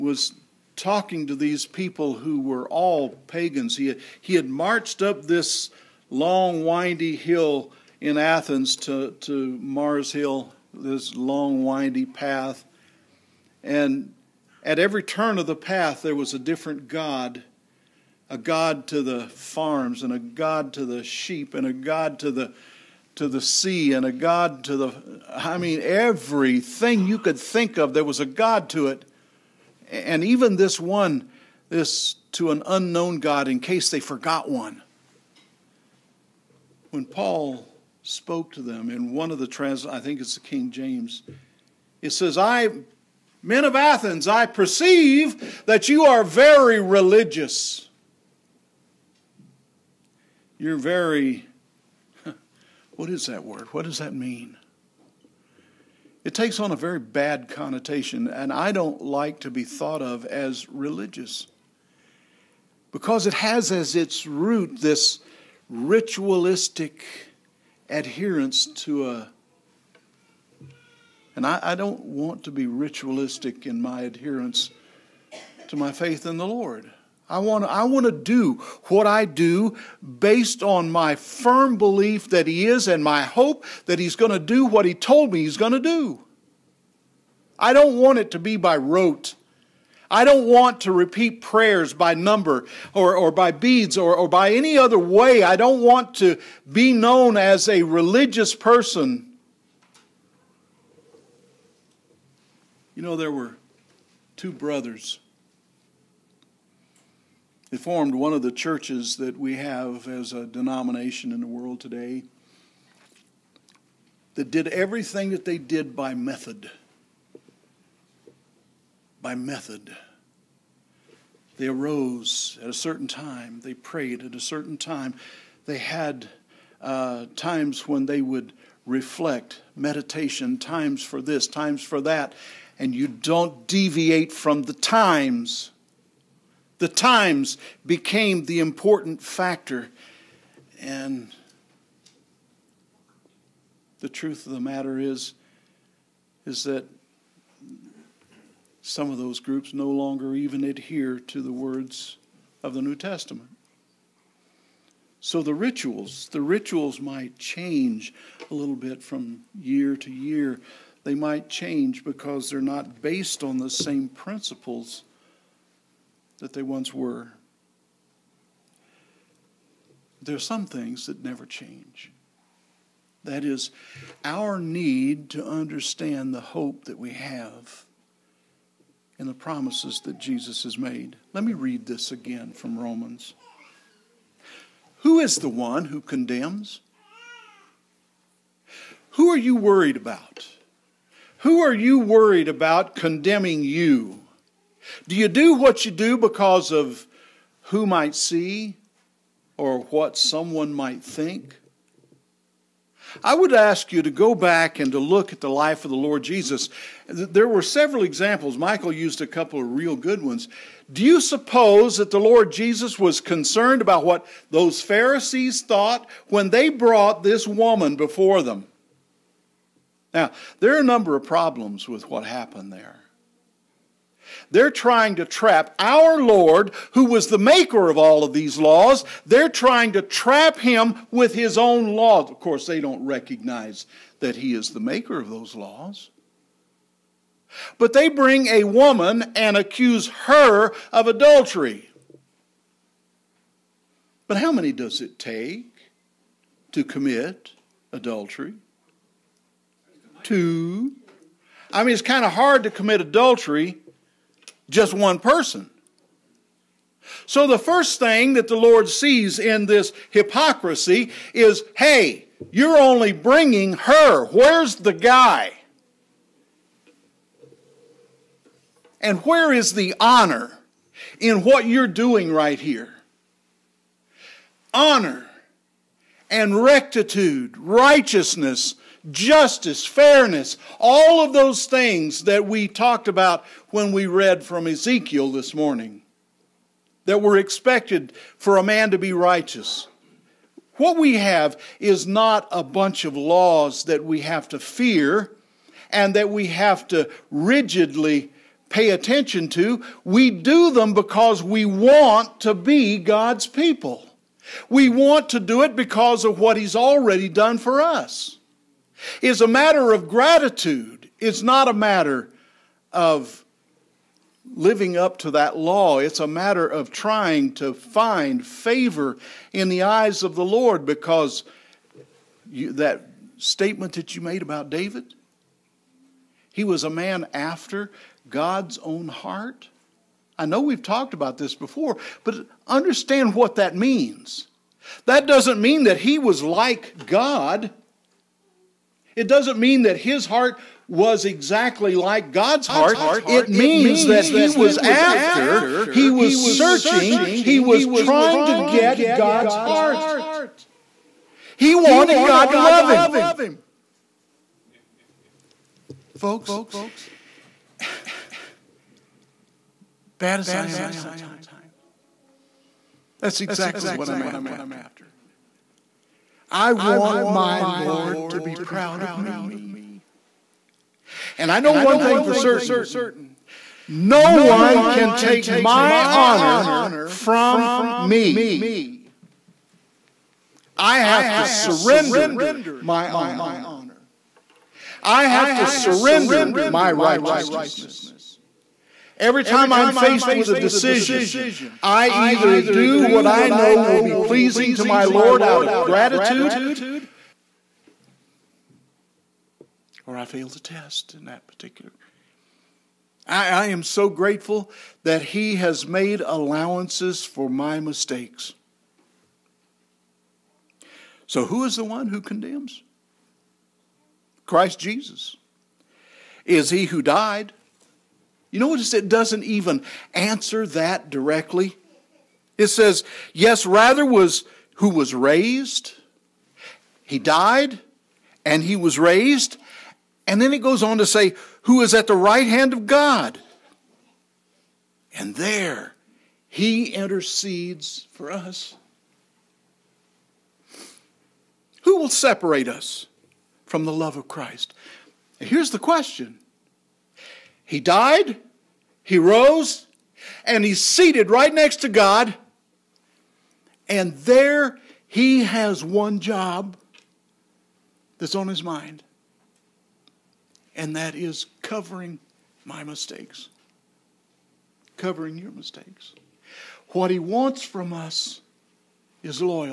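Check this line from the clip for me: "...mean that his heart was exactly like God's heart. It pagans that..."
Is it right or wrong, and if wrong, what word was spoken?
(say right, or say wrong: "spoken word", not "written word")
wrong: "means", not "pagans".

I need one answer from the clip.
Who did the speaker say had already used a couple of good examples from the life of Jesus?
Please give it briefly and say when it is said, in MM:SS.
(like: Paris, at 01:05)
Michael, at 03:28.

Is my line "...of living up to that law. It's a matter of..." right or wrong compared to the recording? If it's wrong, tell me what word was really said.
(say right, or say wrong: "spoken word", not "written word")
right.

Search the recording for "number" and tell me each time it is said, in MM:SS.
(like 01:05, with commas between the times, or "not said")
01:32, 03:40.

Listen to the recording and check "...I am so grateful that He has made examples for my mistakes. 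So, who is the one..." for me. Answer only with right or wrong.
wrong.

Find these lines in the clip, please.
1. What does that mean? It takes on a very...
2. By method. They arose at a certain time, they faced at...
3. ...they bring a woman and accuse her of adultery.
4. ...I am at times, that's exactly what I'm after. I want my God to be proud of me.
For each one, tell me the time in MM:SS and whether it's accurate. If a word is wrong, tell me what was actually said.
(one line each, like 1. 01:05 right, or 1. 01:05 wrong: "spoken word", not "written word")
1. 00:53 right
2. 01:59 wrong: "prayed", not "faced"
3. 03:57 right
4. 06:00 wrong: "Lord", not "God".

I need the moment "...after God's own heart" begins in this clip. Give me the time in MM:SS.
05:27.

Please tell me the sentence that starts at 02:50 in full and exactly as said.
There are some things that never change.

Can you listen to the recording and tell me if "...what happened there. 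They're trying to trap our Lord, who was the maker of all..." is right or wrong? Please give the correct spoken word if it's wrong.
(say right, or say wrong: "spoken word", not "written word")
right.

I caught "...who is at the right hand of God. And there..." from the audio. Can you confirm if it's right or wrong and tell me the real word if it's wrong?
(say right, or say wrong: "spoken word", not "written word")
right.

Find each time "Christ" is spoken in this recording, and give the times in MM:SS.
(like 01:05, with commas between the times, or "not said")
06:54, 07:24.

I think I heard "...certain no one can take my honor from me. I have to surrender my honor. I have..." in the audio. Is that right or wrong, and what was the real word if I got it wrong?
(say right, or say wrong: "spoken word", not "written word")
right.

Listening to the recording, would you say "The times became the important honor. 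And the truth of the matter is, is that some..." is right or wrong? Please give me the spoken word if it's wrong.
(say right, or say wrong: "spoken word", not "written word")
wrong: "factor", not "honor".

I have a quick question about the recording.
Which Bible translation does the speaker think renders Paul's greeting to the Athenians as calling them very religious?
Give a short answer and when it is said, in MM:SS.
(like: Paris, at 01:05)
King James, at 00:40.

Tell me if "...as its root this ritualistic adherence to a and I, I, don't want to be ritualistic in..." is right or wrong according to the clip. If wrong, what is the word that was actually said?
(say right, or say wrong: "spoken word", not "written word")
right.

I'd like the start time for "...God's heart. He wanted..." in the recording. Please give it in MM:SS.
05:49.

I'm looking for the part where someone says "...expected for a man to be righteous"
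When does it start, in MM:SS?
04:47.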